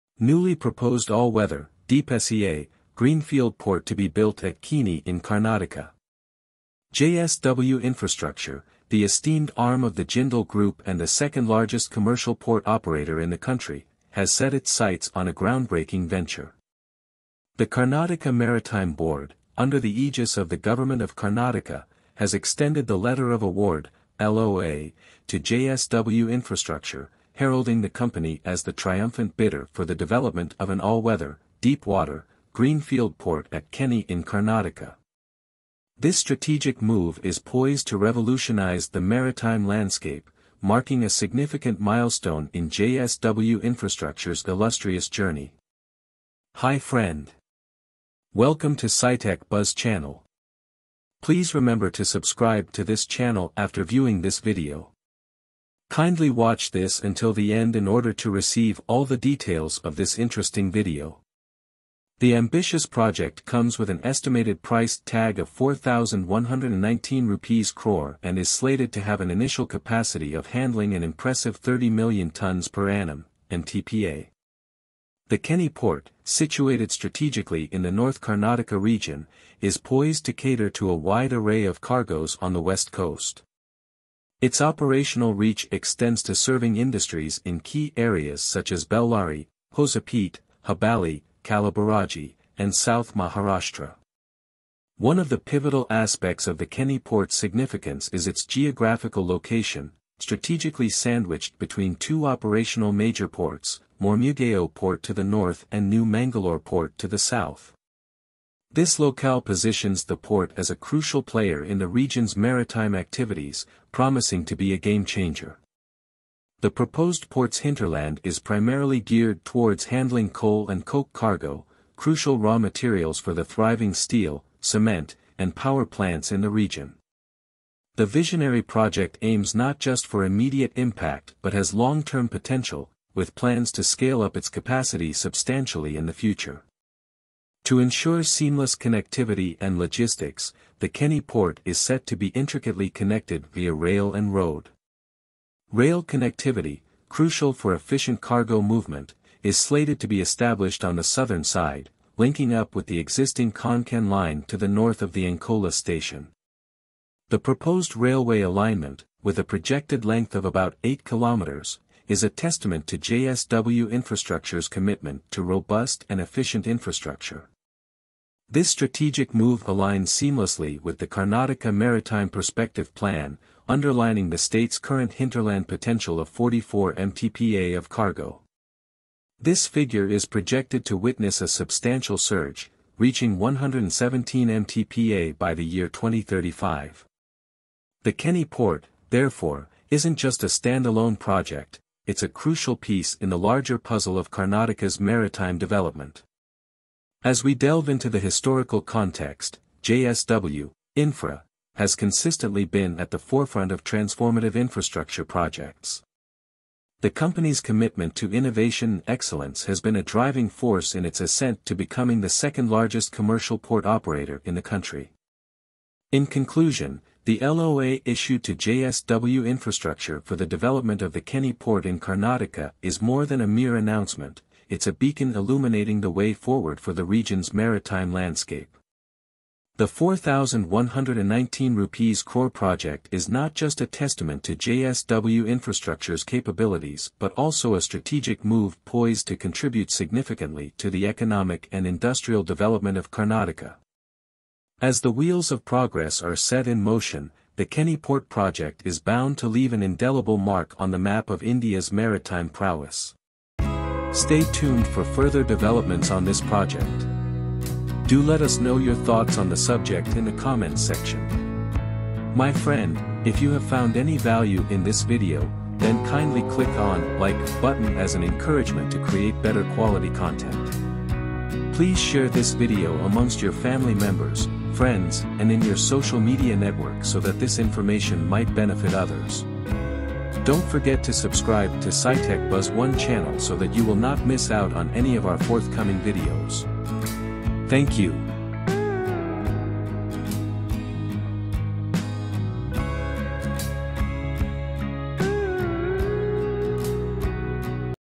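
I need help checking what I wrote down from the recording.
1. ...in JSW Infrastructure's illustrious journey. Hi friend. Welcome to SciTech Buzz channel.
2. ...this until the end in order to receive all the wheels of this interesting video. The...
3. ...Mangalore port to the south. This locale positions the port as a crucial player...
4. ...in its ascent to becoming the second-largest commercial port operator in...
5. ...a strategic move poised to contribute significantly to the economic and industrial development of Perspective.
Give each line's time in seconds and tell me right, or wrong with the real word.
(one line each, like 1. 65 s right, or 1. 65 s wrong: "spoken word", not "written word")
1. 42 s right
2. 56 s wrong: "details", not "wheels"
3. 106 s right
4. 210 s right
5. 237 s wrong: "Karnataka", not "Perspective".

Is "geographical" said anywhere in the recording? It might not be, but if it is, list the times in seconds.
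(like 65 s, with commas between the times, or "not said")
98 s.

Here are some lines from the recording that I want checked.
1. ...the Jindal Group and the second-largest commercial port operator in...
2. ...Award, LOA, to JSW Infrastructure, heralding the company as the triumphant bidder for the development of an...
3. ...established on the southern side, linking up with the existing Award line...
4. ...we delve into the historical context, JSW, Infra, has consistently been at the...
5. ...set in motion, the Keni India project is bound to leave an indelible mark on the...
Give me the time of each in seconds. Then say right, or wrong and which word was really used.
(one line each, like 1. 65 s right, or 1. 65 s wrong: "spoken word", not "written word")
1. 9 s right
2. 23 s right
3. 150 s wrong: "Konkan", not "Award"
4. 197 s right
5. 246 s wrong: "Port", not "India".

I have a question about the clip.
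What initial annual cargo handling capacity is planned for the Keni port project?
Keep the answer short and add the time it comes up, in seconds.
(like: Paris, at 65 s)
30 MTPA, at 71 s.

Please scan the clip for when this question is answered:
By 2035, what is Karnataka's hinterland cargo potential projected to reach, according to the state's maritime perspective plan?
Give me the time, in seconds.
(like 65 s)
183 s.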